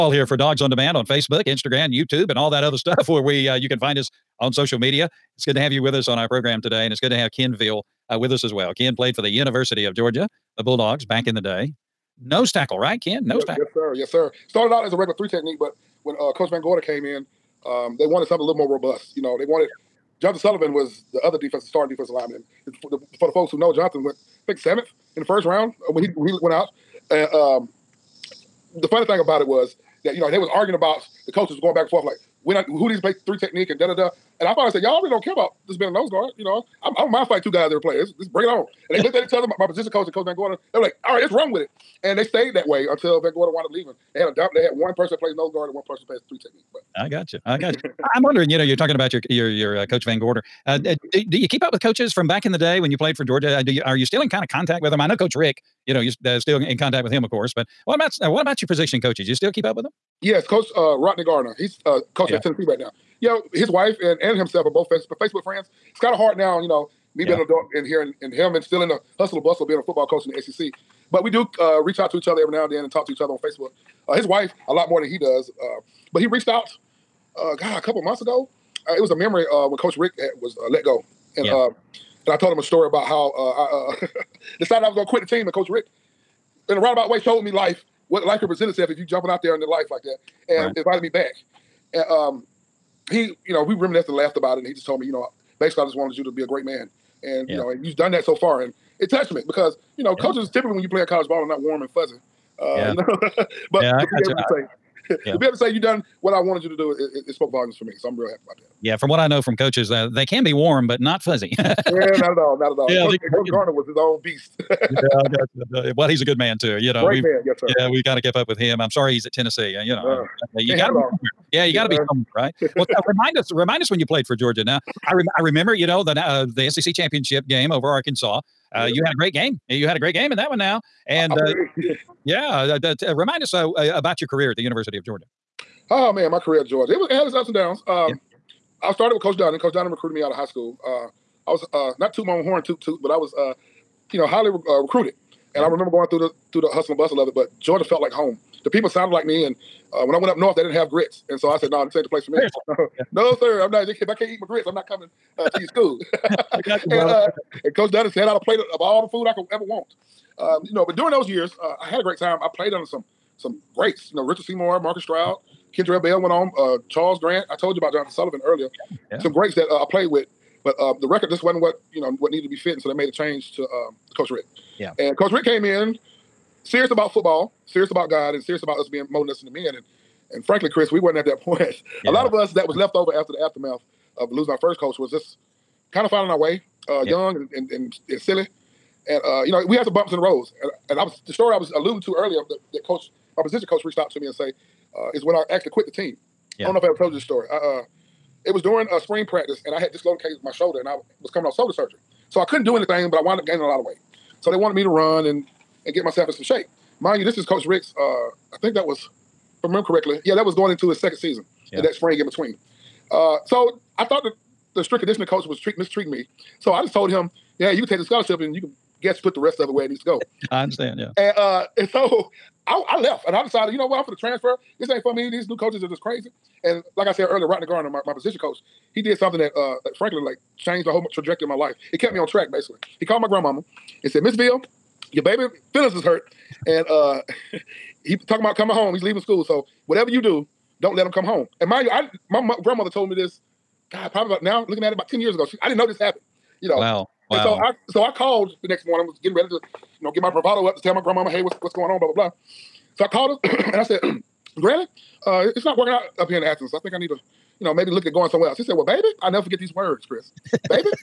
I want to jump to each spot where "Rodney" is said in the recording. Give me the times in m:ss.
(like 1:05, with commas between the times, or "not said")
1:00, 3:47.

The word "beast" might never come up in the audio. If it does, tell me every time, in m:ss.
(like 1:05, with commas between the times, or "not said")
1:54.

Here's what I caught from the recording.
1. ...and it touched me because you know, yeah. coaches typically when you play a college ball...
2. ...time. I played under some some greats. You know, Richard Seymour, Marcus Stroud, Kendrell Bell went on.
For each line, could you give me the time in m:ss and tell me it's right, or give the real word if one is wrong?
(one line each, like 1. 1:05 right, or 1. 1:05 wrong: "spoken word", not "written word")
1. 1:38 right
2. 2:42 right.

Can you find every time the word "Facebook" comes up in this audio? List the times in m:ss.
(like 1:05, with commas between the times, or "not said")
0:01, 1:04, 1:13.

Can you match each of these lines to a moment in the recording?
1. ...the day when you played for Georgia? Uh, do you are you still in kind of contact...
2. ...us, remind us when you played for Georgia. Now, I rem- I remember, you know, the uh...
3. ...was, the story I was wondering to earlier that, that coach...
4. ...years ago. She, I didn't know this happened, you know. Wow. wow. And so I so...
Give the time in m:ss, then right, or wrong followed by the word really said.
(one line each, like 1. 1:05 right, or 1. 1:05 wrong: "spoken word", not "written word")
1. 0:52 right
2. 2:03 right
3. 3:11 wrong: "alluding", not "wondering"
4. 4:05 right.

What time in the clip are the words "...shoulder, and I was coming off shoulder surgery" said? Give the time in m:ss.
3:20.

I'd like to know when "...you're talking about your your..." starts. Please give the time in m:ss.
0:48.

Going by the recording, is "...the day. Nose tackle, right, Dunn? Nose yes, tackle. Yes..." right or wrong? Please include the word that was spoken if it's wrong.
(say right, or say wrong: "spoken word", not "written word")
wrong: "Ken", not "Dunn".